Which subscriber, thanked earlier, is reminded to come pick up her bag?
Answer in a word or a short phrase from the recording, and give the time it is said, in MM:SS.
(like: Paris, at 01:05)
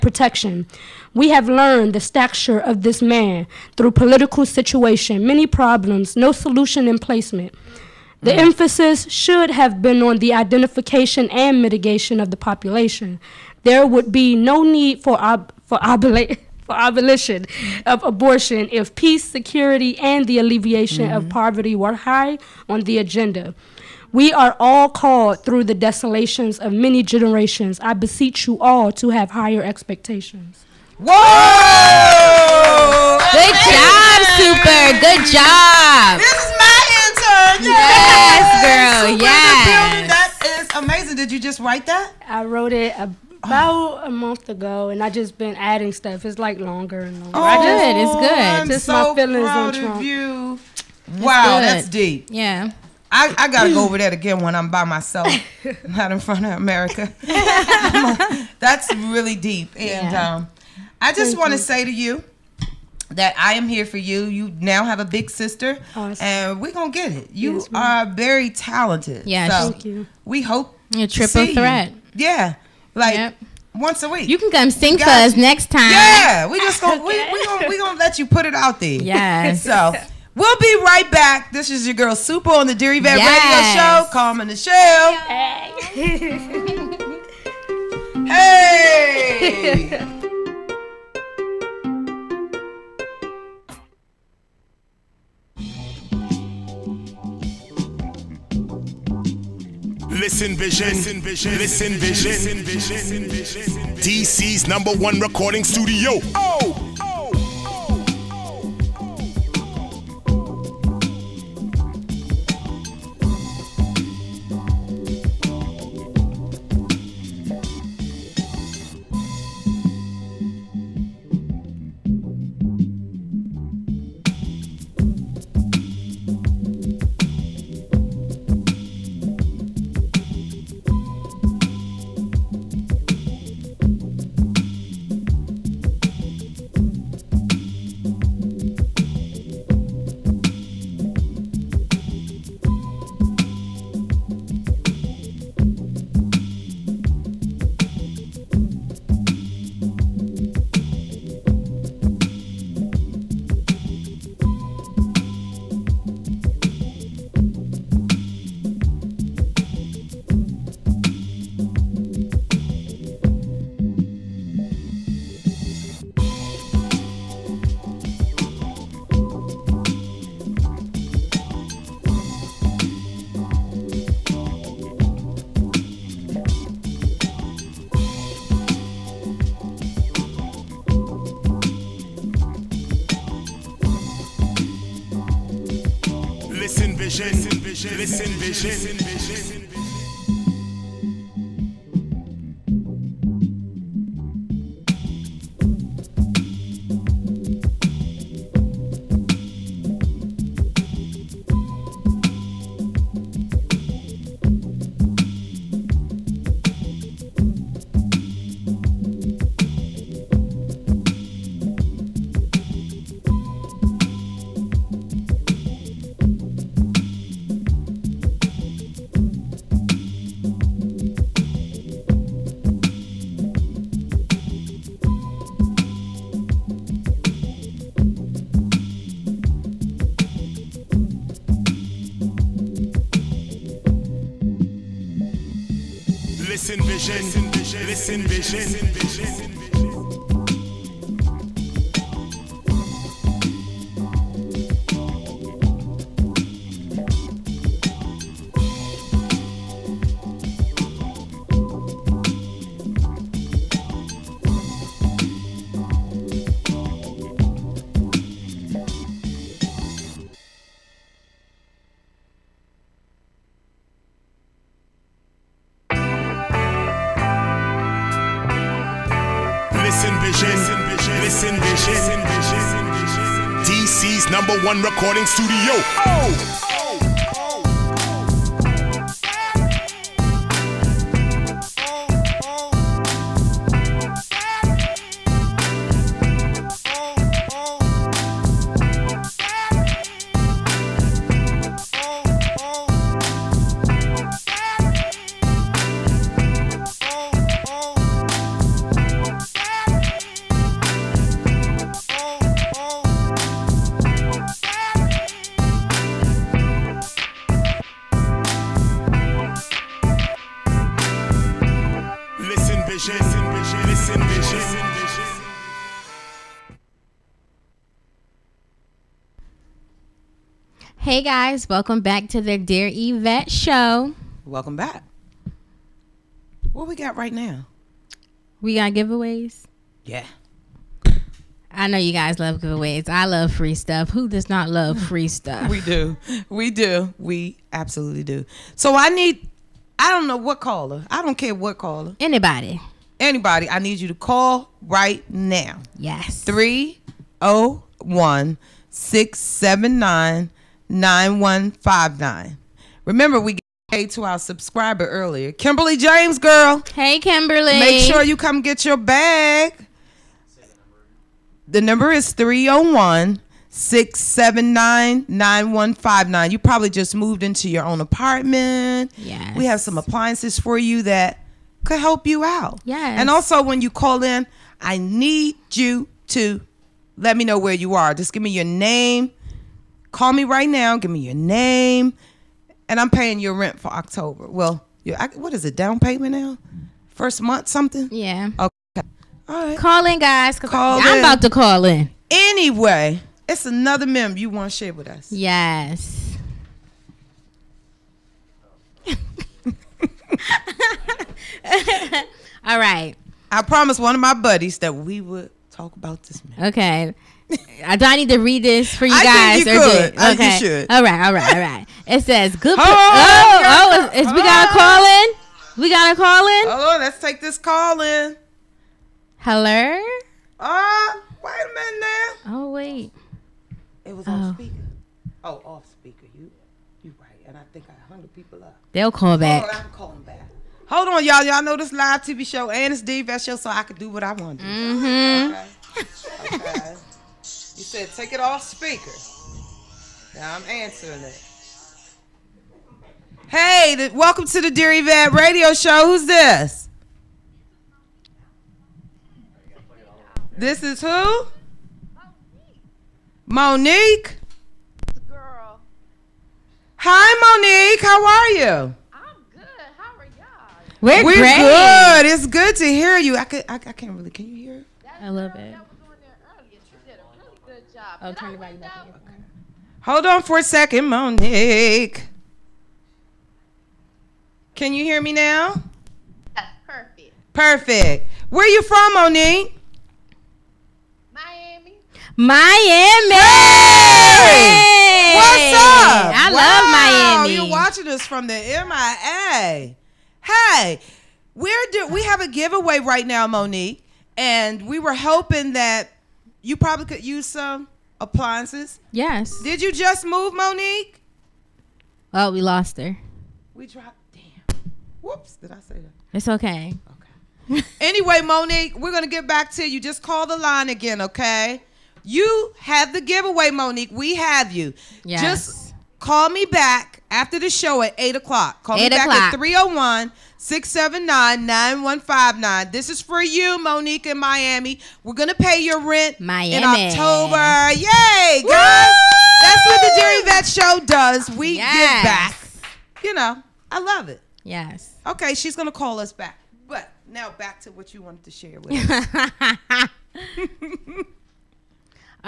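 Kimberly James, at 05:55.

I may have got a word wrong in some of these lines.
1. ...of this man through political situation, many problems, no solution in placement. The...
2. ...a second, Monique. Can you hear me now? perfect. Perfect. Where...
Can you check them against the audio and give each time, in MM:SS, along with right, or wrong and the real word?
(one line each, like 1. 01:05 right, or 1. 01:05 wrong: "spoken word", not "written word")
1. 00:02 right
2. 07:50 right.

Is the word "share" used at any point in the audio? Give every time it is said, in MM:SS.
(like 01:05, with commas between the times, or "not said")
06:34, 08:58.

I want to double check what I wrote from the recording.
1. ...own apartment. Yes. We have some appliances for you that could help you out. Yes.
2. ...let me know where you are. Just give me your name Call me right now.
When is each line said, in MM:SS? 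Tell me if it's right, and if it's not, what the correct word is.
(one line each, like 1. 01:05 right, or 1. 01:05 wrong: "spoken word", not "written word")
1. 06:07 right
2. 06:17 right.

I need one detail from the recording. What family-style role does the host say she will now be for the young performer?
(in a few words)
big sister.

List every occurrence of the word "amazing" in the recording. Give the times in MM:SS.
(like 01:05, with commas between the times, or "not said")
00:40.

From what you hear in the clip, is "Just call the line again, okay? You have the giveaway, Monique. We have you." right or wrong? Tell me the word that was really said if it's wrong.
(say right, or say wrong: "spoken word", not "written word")
right.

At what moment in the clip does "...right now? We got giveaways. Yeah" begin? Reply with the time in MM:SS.
05:27.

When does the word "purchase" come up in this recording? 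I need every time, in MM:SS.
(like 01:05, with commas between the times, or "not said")
not said.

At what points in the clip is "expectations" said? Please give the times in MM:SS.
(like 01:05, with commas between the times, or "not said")
00:29.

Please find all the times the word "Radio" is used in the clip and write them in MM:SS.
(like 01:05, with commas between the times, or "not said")
01:24, 07:25.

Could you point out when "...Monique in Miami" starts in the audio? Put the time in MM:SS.
08:43.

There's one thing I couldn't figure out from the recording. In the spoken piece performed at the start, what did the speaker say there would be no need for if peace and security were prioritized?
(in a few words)
abolition of abortion.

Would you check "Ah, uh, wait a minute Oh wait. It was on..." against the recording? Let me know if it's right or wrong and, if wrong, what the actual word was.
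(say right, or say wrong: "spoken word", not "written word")
right.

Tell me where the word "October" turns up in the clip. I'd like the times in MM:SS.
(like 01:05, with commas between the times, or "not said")
06:23, 08:46.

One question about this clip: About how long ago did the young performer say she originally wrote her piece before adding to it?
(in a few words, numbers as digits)
a month ago.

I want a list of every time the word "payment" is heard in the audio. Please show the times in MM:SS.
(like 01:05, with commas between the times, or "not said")
06:25.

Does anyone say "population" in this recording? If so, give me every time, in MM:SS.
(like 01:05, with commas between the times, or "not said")
00:12.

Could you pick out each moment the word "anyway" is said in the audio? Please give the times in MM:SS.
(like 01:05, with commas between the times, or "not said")
06:32, 08:27.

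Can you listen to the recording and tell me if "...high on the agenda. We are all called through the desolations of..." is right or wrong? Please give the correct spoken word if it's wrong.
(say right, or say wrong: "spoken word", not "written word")
right.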